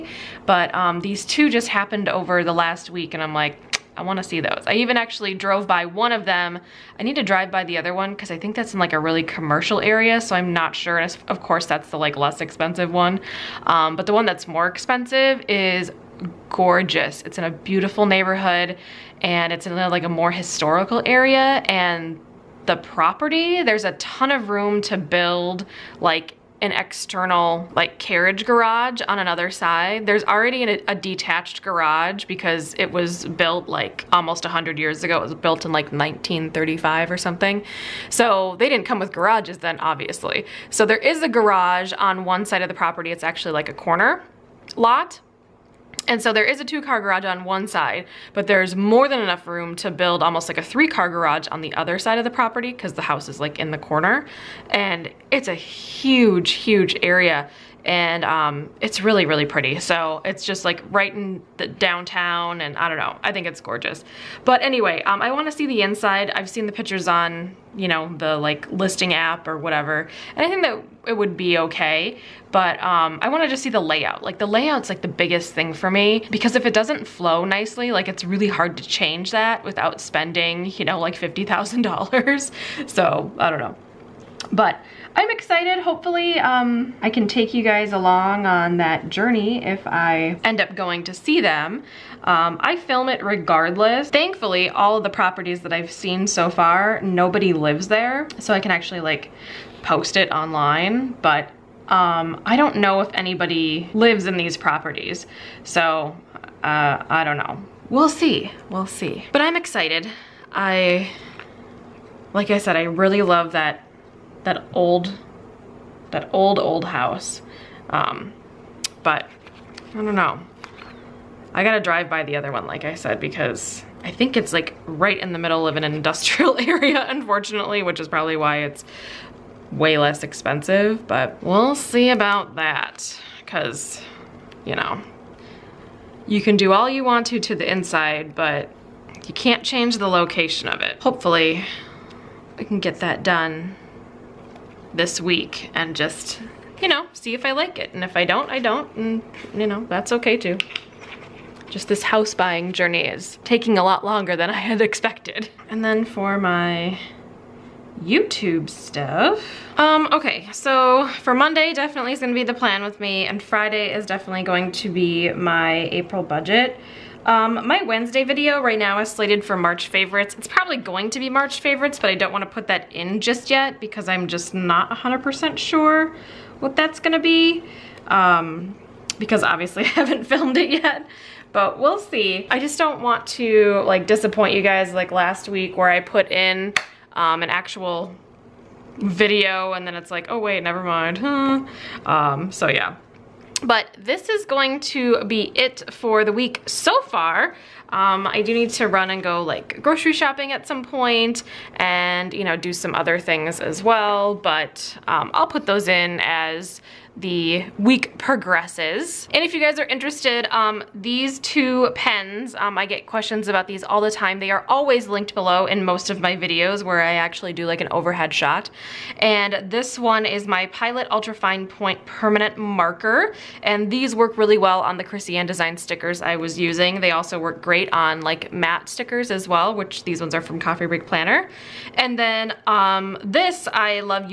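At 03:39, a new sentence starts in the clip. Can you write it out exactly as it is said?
And this one is my Pilot Ultra Fine Point Permanent Marker.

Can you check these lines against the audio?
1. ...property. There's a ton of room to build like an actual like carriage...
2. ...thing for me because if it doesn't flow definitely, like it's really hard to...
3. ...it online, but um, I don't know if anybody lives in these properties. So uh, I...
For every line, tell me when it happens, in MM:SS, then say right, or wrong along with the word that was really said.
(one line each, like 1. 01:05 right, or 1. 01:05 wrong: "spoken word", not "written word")
1. 00:22 wrong: "external", not "actual"
2. 01:15 wrong: "nicely", not "definitely"
3. 01:40 right.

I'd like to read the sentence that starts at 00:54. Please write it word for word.
And it's a huge, huge area and um, it's really, really pretty.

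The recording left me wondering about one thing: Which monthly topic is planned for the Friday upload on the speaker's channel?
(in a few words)
April budget.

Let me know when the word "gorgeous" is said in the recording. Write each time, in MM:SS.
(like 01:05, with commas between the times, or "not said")
00:16, 01:03.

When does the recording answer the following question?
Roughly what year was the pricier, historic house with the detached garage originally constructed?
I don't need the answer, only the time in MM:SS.
00:35.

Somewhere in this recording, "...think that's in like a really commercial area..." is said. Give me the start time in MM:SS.
00:08.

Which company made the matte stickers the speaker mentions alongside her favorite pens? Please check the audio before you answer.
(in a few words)
Coffee Break Planner.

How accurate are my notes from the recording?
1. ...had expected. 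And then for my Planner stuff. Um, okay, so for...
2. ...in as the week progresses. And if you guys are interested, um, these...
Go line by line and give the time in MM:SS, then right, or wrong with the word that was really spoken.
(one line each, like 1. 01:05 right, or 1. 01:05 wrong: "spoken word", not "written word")
1. 02:34 wrong: "YouTube", not "Planner"
2. 03:25 right.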